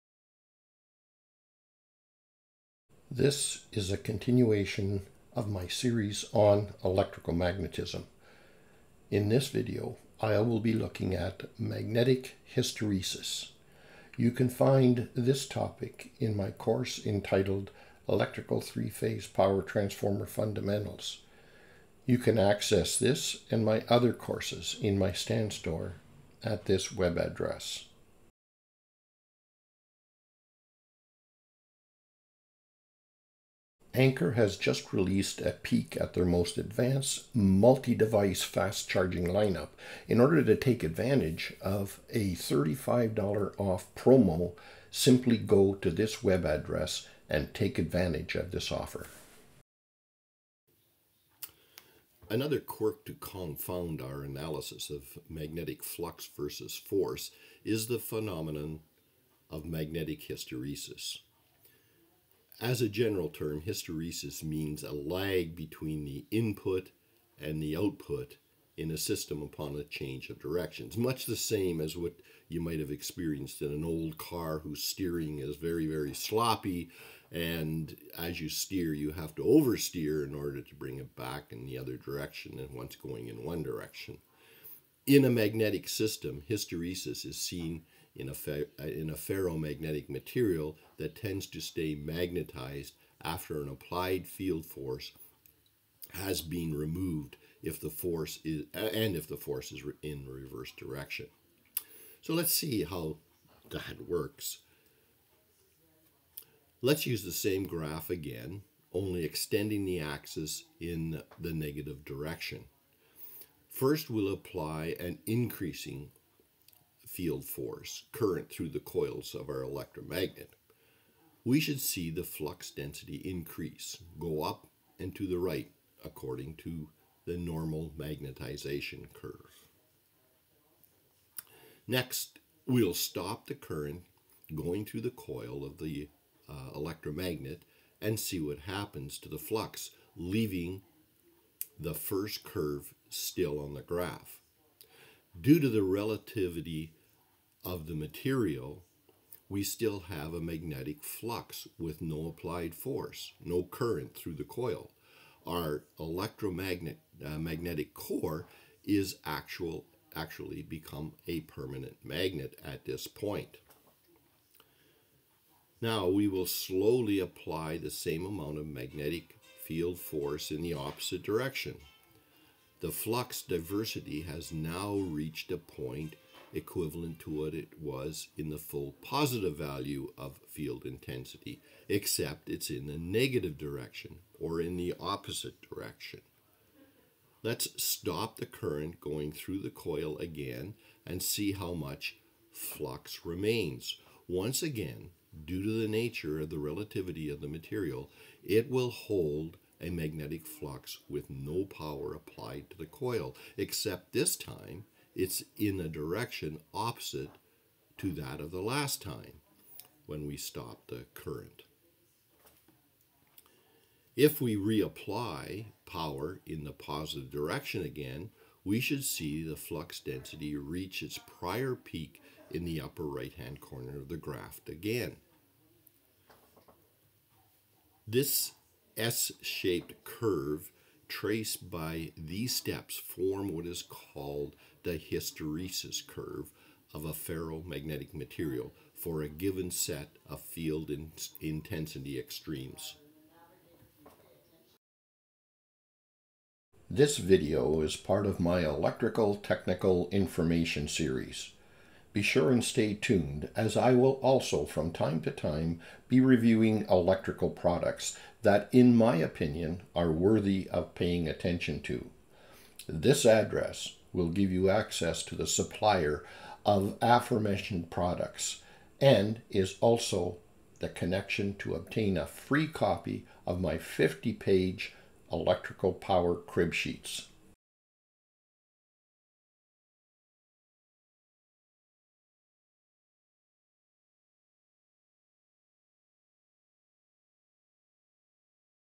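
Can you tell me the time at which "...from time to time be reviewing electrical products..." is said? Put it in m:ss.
4:14.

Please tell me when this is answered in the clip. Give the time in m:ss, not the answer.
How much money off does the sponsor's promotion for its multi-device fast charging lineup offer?
0:42.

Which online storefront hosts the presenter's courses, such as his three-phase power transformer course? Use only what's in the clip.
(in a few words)
Stan Store.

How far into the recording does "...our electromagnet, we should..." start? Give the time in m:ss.
1:59.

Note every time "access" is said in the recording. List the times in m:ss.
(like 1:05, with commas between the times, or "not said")
0:22, 4:24.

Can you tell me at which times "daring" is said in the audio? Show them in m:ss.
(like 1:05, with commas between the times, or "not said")
not said.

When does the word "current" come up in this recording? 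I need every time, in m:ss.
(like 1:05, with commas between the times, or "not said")
1:58, 2:13, 2:33, 3:08, 3:31.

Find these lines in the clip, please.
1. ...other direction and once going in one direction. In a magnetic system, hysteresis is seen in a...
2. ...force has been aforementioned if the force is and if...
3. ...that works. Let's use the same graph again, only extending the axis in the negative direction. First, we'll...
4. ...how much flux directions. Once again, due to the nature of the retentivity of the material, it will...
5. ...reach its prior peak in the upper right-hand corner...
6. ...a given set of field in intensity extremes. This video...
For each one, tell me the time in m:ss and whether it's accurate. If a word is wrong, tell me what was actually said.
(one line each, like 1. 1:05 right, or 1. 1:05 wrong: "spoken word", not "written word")
1. 1:21 right
2. 1:34 wrong: "removed", not "aforementioned"
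3. 1:43 right
4. 3:11 wrong: "remains", not "directions"
5. 3:40 right
6. 3:59 right.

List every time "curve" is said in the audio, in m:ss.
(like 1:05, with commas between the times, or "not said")
2:09, 2:22, 3:50, 3:56.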